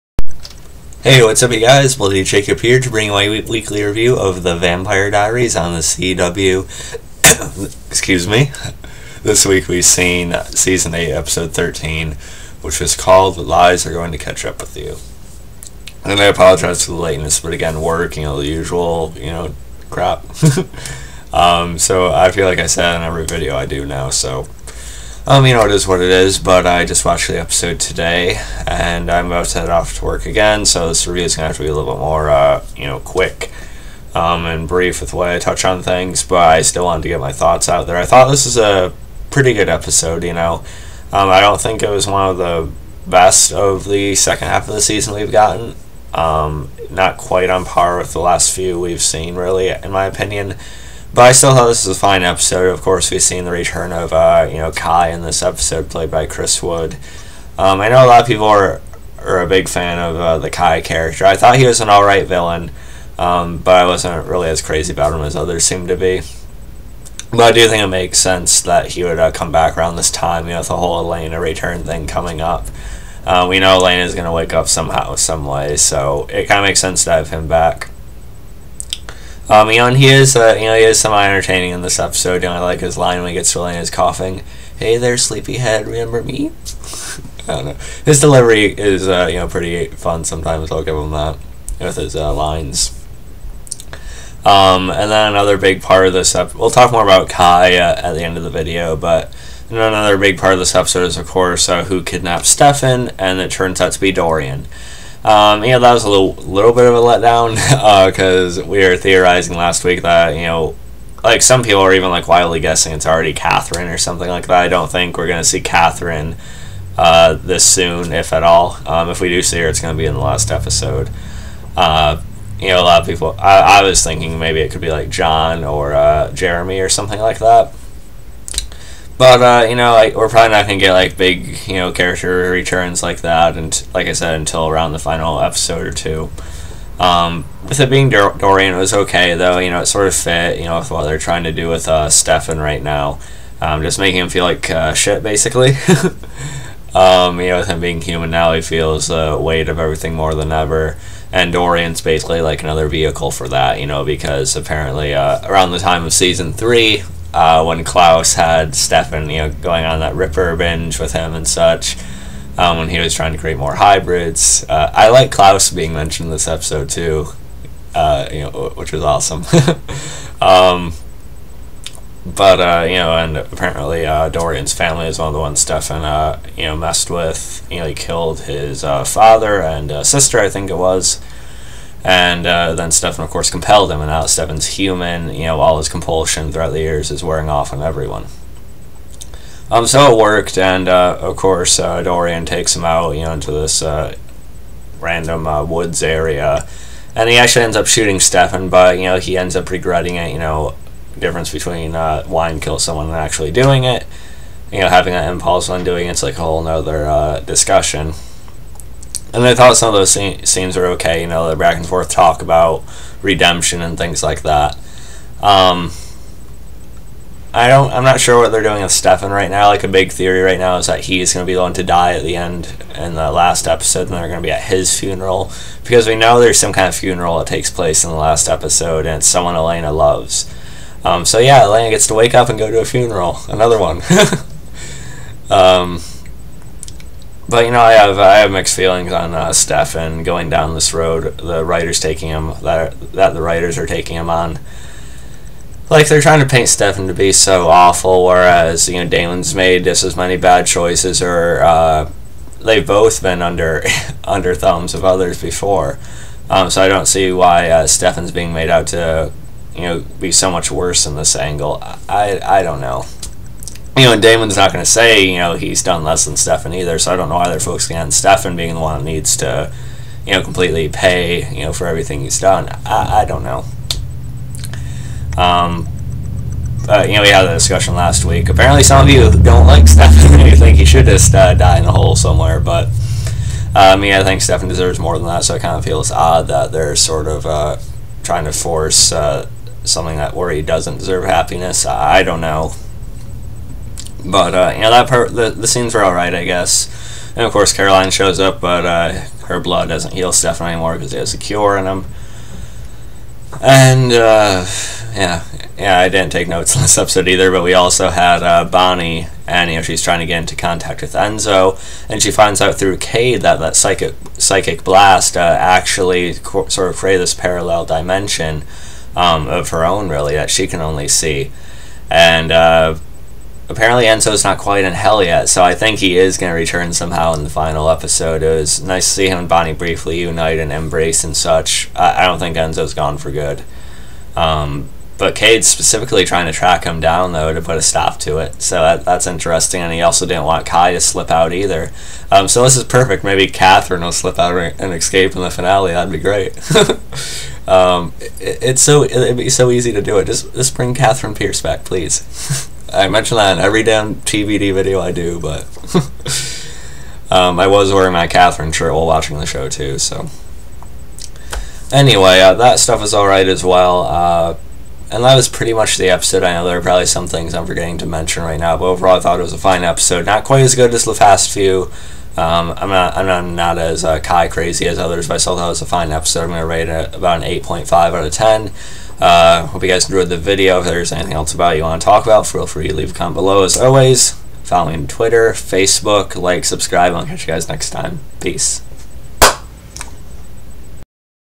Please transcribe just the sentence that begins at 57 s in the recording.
Um, I know a lot of people are are a big fan of uh, the Kai character.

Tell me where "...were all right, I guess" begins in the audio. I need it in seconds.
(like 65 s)
295 s.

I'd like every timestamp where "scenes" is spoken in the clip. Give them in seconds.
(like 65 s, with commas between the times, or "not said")
210 s, 295 s.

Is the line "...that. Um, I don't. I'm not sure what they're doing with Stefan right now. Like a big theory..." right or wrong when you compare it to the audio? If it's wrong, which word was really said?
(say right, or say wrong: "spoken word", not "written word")
right.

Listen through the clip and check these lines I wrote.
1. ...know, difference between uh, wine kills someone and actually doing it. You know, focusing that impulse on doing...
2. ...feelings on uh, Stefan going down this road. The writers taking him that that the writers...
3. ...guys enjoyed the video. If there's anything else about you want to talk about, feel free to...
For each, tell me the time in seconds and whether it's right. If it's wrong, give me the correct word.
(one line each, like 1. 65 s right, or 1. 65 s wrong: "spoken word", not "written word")
1. 200 s wrong: "having", not "focusing"
2. 238 s right
3. 379 s right.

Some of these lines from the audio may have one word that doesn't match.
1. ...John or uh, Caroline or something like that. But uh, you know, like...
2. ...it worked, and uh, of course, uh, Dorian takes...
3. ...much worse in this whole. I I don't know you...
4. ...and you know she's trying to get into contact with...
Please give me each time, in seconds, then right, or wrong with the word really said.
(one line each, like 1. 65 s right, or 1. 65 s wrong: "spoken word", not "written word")
1. 125 s wrong: "Jeremy", not "Caroline"
2. 190 s right
3. 260 s wrong: "angle", not "whole"
4. 309 s right.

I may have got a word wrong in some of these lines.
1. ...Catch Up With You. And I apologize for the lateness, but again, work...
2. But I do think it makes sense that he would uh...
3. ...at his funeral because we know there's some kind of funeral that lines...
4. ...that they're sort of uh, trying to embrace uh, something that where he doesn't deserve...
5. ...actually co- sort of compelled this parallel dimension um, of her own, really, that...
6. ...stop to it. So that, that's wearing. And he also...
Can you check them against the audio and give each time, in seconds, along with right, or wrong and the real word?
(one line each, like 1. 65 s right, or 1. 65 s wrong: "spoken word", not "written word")
1. 14 s right
2. 67 s right
3. 224 s wrong: "takes", not "lines"
4. 286 s wrong: "force", not "embrace"
5. 315 s wrong: "created", not "compelled"
6. 337 s wrong: "interesting", not "wearing".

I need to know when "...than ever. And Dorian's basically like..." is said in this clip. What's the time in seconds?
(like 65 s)
150 s.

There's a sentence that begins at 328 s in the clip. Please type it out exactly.
It was nice to see him and Bonnie briefly unite and embrace and such.